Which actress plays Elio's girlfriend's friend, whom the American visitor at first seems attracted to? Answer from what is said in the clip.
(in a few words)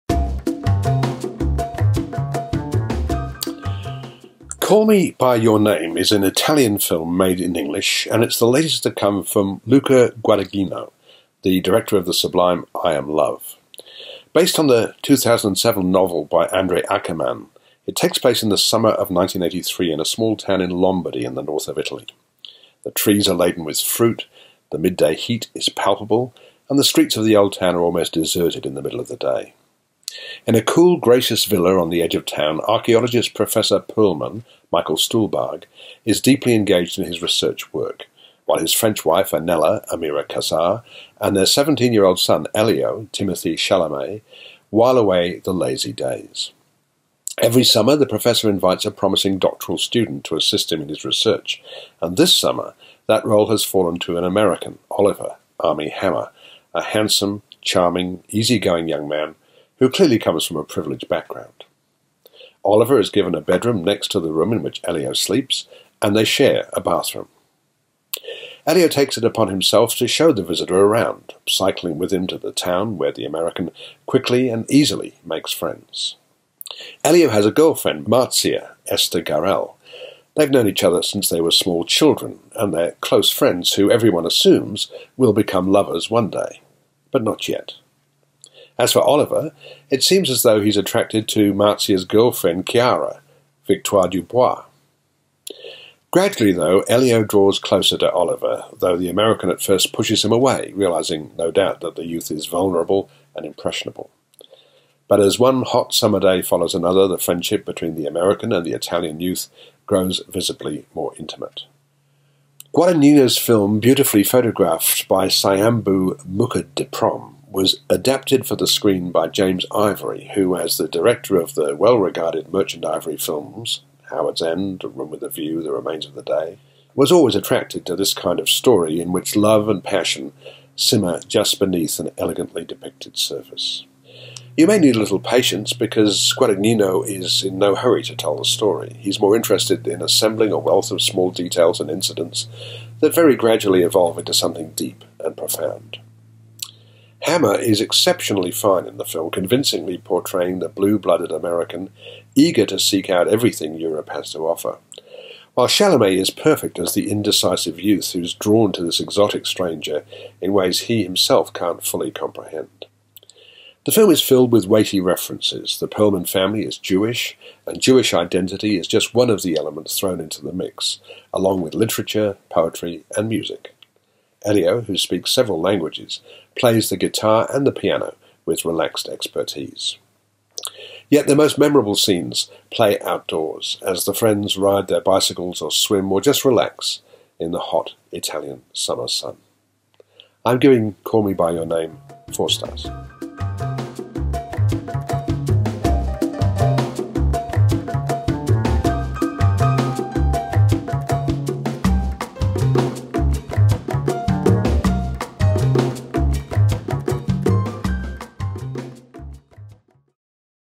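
Victoire Dubois.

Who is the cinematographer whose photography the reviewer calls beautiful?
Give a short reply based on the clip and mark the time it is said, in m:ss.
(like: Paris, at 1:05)
Sayombhu Prom, at 1:55.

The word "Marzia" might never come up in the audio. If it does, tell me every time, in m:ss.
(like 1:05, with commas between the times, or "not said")
1:18, 1:31.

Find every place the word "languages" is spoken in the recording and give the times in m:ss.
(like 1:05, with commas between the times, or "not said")
2:55.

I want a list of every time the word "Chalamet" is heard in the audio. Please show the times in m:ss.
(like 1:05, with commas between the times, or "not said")
0:43, 2:35.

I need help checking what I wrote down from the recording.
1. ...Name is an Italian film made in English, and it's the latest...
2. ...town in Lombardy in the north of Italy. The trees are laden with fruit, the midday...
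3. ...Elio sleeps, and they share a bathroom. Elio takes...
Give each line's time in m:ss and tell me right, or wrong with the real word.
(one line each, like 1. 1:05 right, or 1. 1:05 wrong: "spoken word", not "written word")
1. 0:05 right
2. 0:20 right
3. 1:04 right.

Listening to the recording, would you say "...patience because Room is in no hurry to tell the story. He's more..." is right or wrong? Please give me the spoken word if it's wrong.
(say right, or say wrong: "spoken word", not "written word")
wrong: "Guadagnino", not "Room".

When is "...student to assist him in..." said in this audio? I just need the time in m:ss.
0:49.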